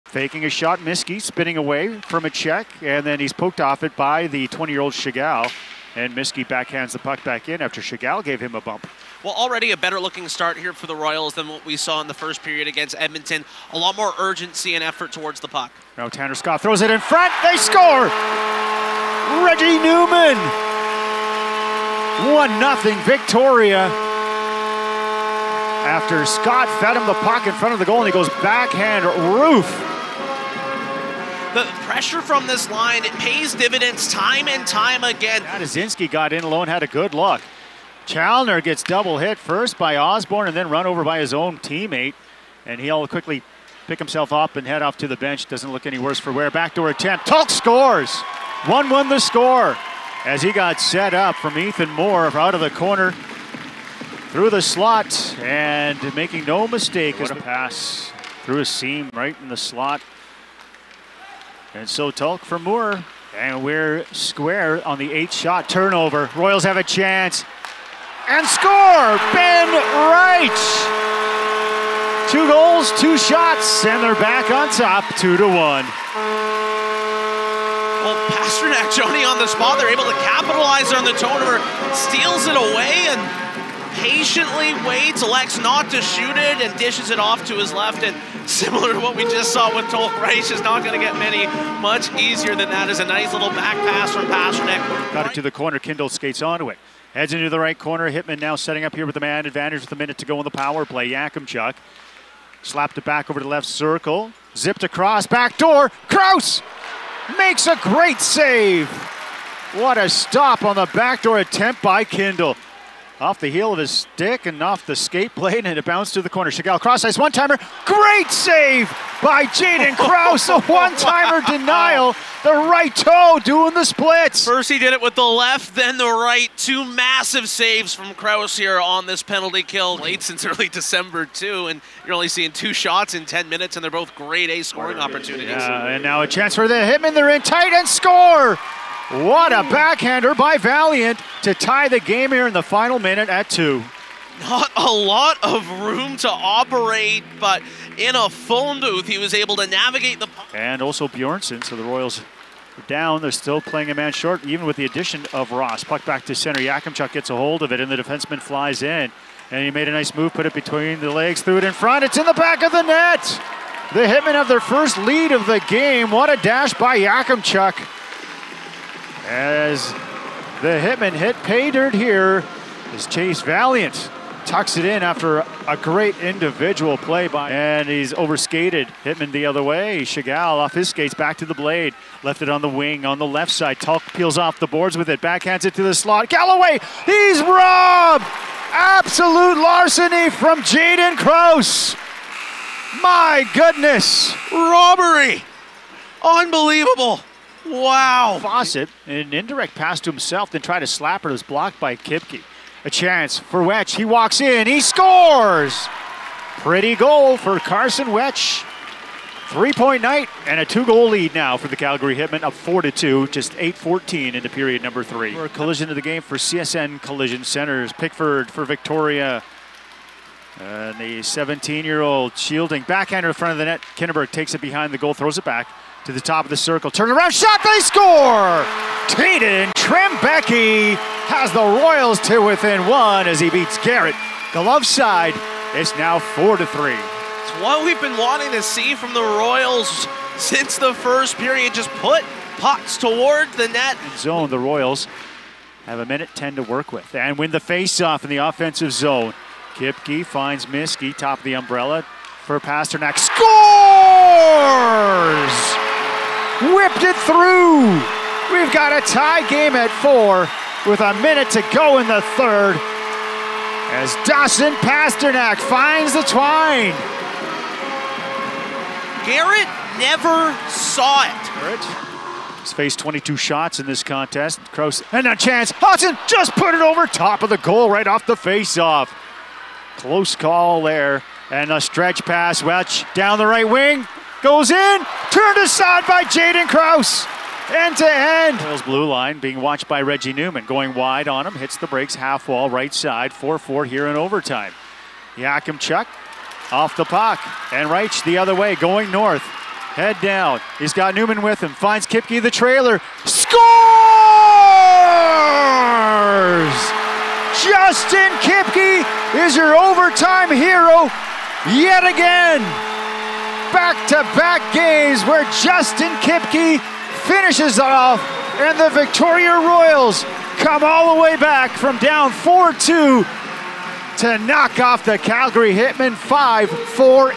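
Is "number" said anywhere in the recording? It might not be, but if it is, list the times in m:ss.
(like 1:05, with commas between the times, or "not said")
3:34.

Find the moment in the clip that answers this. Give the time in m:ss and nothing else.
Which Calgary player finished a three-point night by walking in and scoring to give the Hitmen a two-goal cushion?
3:27.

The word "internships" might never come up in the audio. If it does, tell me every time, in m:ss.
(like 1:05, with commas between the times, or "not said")
not said.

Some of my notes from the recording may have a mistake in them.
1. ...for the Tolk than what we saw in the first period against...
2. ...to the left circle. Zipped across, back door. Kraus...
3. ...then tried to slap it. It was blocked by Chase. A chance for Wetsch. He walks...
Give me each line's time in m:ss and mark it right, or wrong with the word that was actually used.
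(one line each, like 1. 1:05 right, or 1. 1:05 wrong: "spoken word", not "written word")
1. 0:10 wrong: "Royals", not "Tolk"
2. 1:43 right
3. 3:20 wrong: "Kipkie", not "Chase".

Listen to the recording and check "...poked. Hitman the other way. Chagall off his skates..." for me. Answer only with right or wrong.
wrong.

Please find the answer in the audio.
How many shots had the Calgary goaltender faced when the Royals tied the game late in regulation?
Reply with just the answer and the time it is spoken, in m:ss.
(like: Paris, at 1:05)
22, at 4:32.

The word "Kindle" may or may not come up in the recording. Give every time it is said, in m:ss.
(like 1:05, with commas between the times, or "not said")
1:35, 1:52.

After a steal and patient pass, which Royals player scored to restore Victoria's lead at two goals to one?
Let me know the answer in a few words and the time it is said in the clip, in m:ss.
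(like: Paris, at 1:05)
Ben Wright, at 1:09.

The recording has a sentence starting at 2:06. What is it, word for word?
Two massive saves from Kraus here on this penalty kill.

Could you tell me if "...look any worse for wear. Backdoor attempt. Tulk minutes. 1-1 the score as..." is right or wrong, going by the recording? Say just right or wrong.
wrong.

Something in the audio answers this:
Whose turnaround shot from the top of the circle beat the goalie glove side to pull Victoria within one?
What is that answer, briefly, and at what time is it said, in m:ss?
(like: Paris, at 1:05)
Teydon Trembecki, at 3:49.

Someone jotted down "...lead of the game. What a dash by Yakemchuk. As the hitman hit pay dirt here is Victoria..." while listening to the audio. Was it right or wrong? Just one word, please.
wrong.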